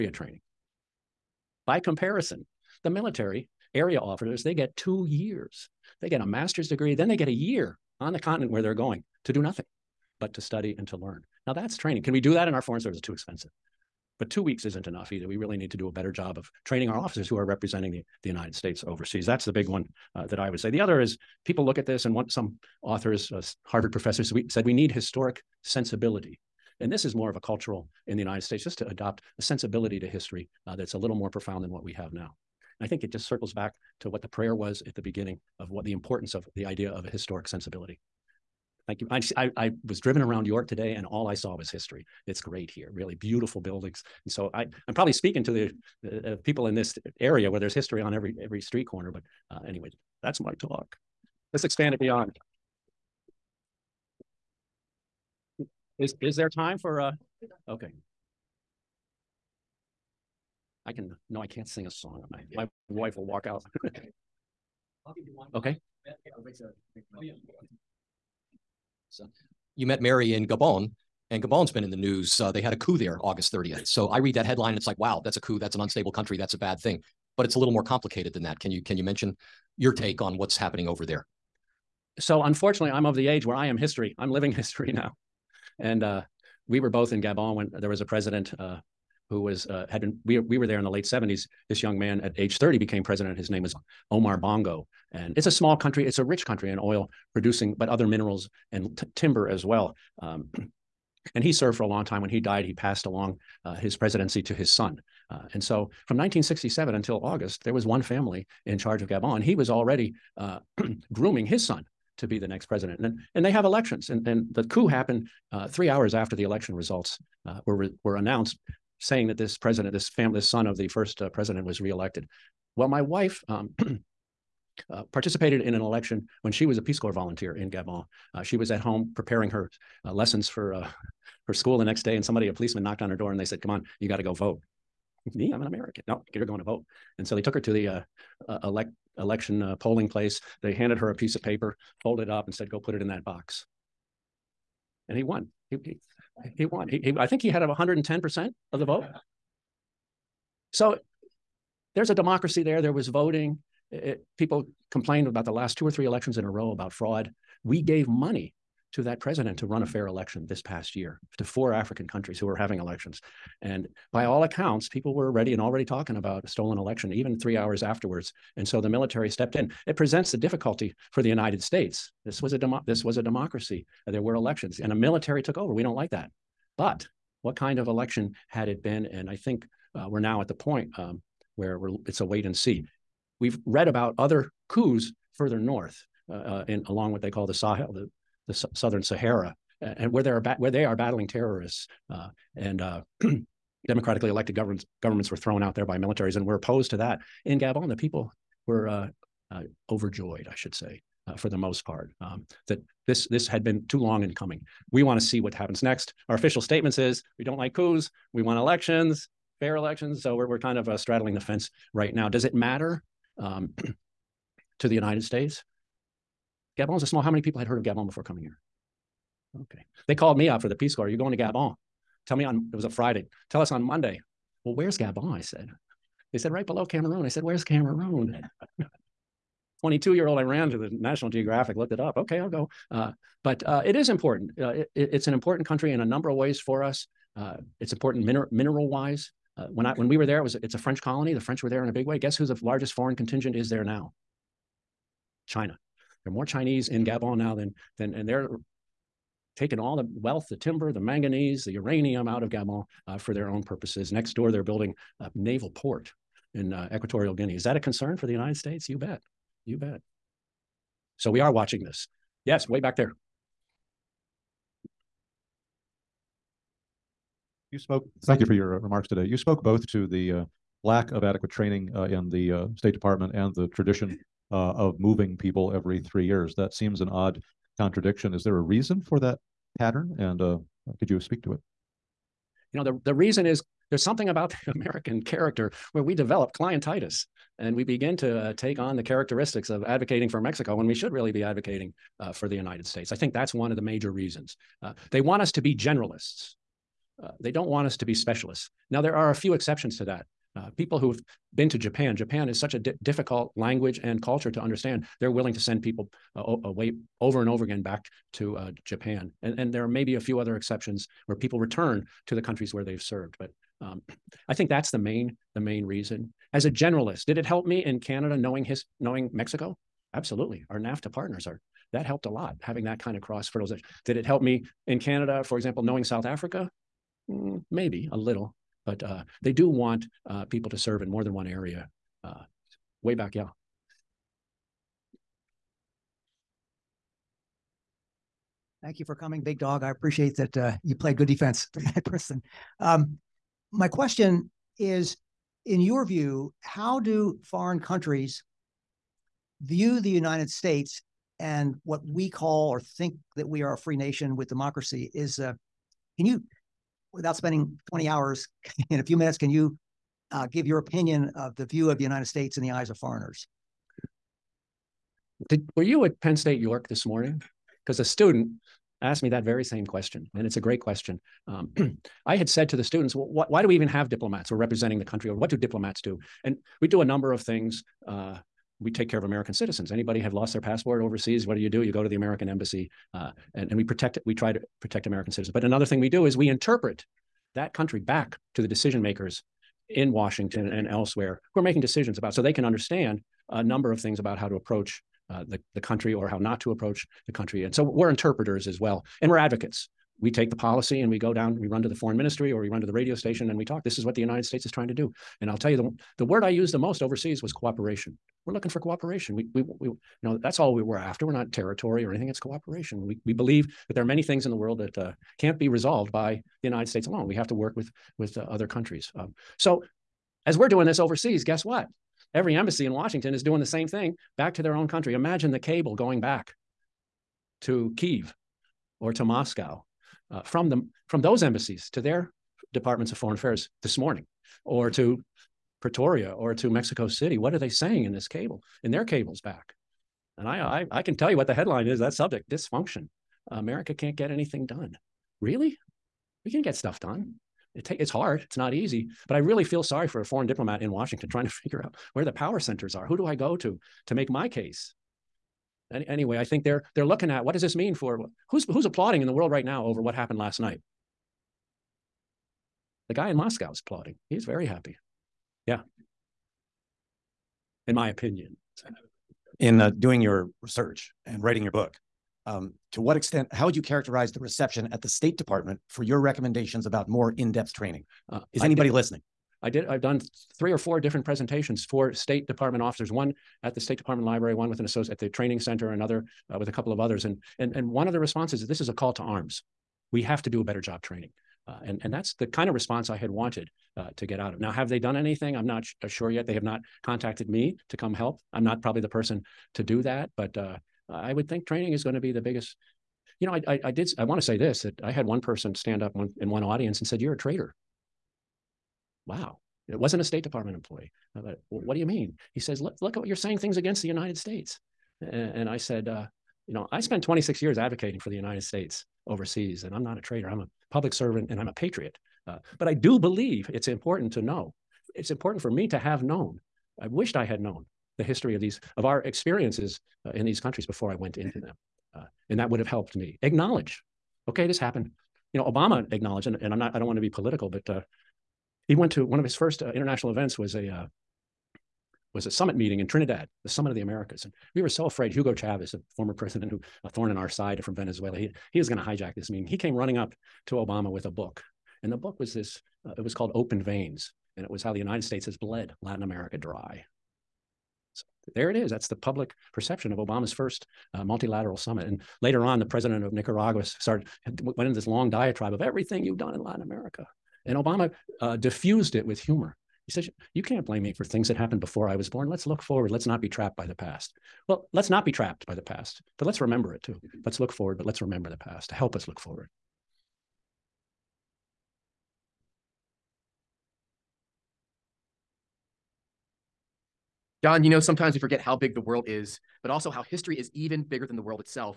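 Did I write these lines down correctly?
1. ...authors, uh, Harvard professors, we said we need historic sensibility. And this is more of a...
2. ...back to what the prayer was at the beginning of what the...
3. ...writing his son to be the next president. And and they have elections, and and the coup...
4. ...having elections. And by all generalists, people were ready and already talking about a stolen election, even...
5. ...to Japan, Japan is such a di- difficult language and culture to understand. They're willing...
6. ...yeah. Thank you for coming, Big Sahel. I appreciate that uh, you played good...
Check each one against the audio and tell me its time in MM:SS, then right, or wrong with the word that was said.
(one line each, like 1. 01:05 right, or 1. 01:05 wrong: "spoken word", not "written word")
1. 00:22 right
2. 00:33 right
3. 01:51 wrong: "grooming", not "writing"
4. 02:42 wrong: "accounts", not "generalists"
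5. 05:01 right
6. 05:33 wrong: "Dog", not "Sahel".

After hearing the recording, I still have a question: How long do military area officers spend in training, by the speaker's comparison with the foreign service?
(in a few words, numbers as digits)
2 years.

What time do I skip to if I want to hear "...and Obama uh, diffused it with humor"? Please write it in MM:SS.
09:27.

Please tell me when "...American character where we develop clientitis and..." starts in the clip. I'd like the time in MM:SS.
04:44.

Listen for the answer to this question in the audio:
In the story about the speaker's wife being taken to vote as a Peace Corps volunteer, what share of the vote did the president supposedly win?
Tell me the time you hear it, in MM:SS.
02:27.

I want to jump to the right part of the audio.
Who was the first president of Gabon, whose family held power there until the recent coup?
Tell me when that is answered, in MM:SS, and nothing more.
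01:34.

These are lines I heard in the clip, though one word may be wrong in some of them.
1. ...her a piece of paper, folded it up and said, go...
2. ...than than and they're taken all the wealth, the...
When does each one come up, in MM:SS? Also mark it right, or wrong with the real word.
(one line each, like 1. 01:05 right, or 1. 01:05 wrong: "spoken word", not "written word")
1. 02:20 right
2. 04:07 right.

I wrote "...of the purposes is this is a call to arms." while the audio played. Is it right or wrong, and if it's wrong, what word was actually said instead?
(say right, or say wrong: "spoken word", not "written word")
wrong: "responses", not "purposes".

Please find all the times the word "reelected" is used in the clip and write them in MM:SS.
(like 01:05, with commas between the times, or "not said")
02:01.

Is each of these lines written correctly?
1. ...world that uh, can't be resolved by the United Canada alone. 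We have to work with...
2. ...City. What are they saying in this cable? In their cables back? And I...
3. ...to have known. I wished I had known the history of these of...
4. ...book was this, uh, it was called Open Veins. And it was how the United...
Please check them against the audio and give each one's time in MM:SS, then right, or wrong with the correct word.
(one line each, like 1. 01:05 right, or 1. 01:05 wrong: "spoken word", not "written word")
1. 06:54 wrong: "States", not "Canada"
2. 07:17 right
3. 08:45 right
4. 09:12 right.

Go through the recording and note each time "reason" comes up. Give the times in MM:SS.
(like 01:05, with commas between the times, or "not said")
04:38, 04:43, 04:54, 05:15.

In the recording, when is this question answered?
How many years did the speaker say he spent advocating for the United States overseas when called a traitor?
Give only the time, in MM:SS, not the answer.
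08:37.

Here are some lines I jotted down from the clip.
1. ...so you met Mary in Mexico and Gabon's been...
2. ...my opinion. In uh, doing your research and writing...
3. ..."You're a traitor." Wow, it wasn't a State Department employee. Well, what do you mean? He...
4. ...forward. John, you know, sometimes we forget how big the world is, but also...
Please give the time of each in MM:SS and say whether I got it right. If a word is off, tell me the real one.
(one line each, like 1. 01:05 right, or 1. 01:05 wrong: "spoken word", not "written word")
1. 01:09 wrong: "Gabon", not "Mexico"
2. 07:47 right
3. 08:27 right
4. 09:39 right.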